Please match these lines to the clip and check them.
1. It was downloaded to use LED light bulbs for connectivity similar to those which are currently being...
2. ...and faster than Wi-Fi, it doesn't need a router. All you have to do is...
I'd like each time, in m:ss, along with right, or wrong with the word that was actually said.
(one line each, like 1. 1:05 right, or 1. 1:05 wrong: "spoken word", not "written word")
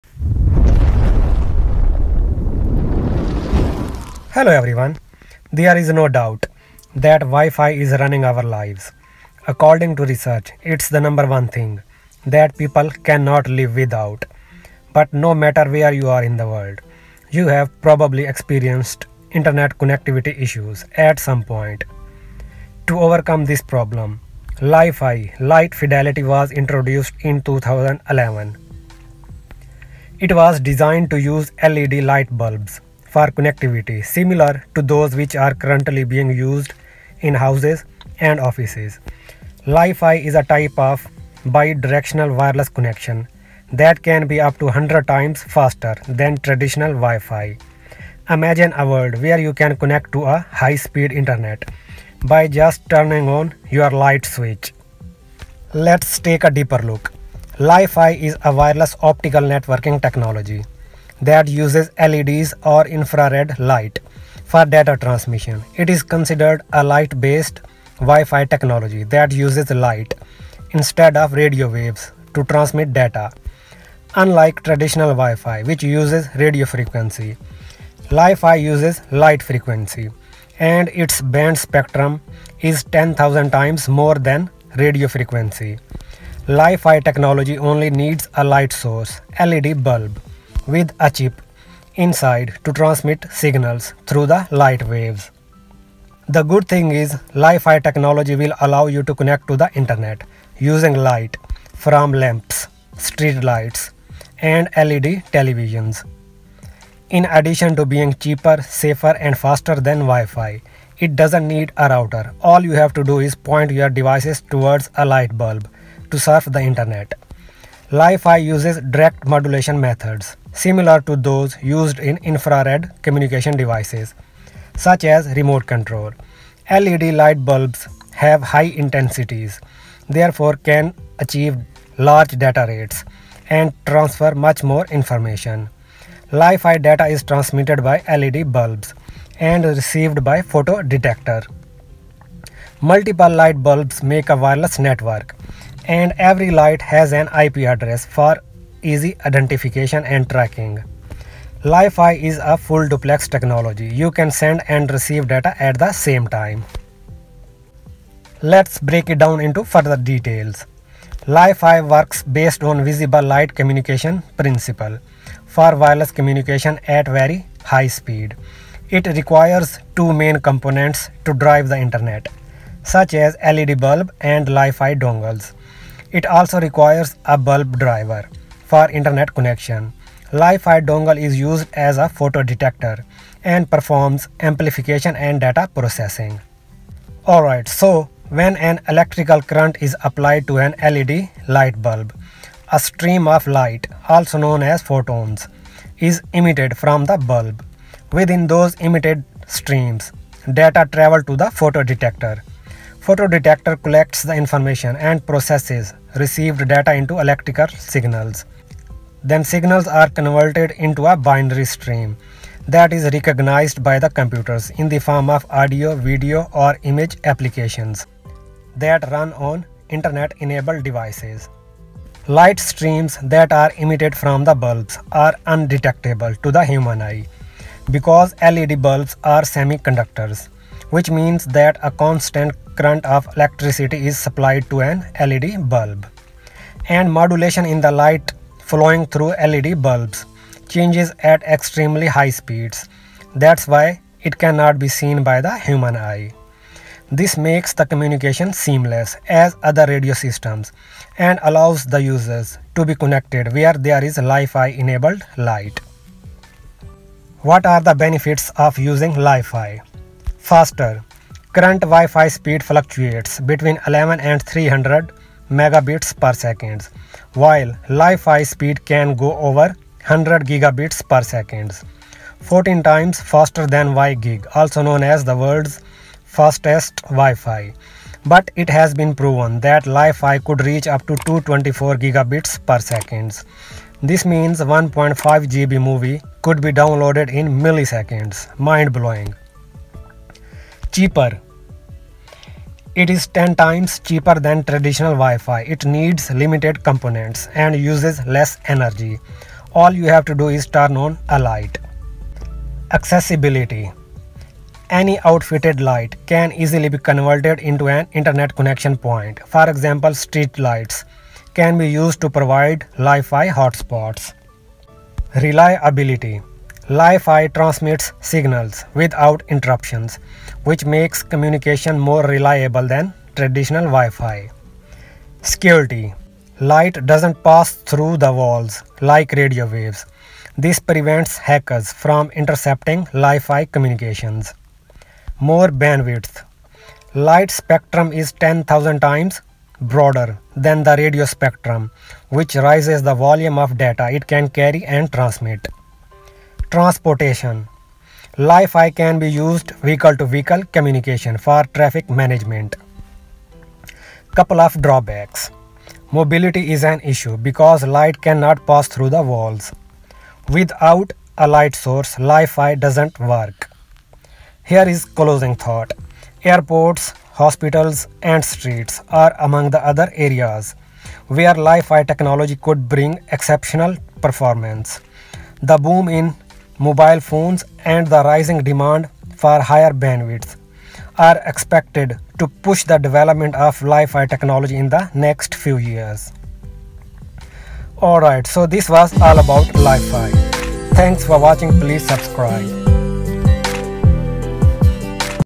1. 0:30 wrong: "designed", not "downloaded"
2. 1:49 right.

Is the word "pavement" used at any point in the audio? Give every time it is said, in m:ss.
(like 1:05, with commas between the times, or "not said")
not said.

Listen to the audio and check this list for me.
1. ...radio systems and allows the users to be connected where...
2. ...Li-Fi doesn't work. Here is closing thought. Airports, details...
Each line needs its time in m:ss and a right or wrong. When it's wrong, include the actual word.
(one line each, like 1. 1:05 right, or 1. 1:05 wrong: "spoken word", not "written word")
1. 4:09 right
2. 6:02 wrong: "hospitals", not "details".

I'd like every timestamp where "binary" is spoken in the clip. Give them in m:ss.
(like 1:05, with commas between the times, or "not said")
3:31.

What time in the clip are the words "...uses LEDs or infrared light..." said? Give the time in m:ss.
1:01.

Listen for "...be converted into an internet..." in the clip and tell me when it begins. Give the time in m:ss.
5:06.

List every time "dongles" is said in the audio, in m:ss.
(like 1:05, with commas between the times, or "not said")
2:54, 3:00.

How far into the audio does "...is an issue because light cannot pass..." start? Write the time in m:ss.
5:56.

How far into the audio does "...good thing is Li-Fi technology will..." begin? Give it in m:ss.
1:36.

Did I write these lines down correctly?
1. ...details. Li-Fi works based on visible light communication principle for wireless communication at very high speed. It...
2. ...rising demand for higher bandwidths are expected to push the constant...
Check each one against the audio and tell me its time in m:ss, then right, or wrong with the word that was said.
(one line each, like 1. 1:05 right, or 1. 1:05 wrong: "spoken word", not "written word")
1. 2:39 right
2. 6:18 wrong: "development", not "constant".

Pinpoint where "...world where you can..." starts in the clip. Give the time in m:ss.
0:48.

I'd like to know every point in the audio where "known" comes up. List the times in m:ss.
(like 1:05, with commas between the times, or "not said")
3:14, 4:34.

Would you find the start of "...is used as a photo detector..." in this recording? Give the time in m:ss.
3:01.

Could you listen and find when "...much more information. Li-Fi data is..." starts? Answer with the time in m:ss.
2:14.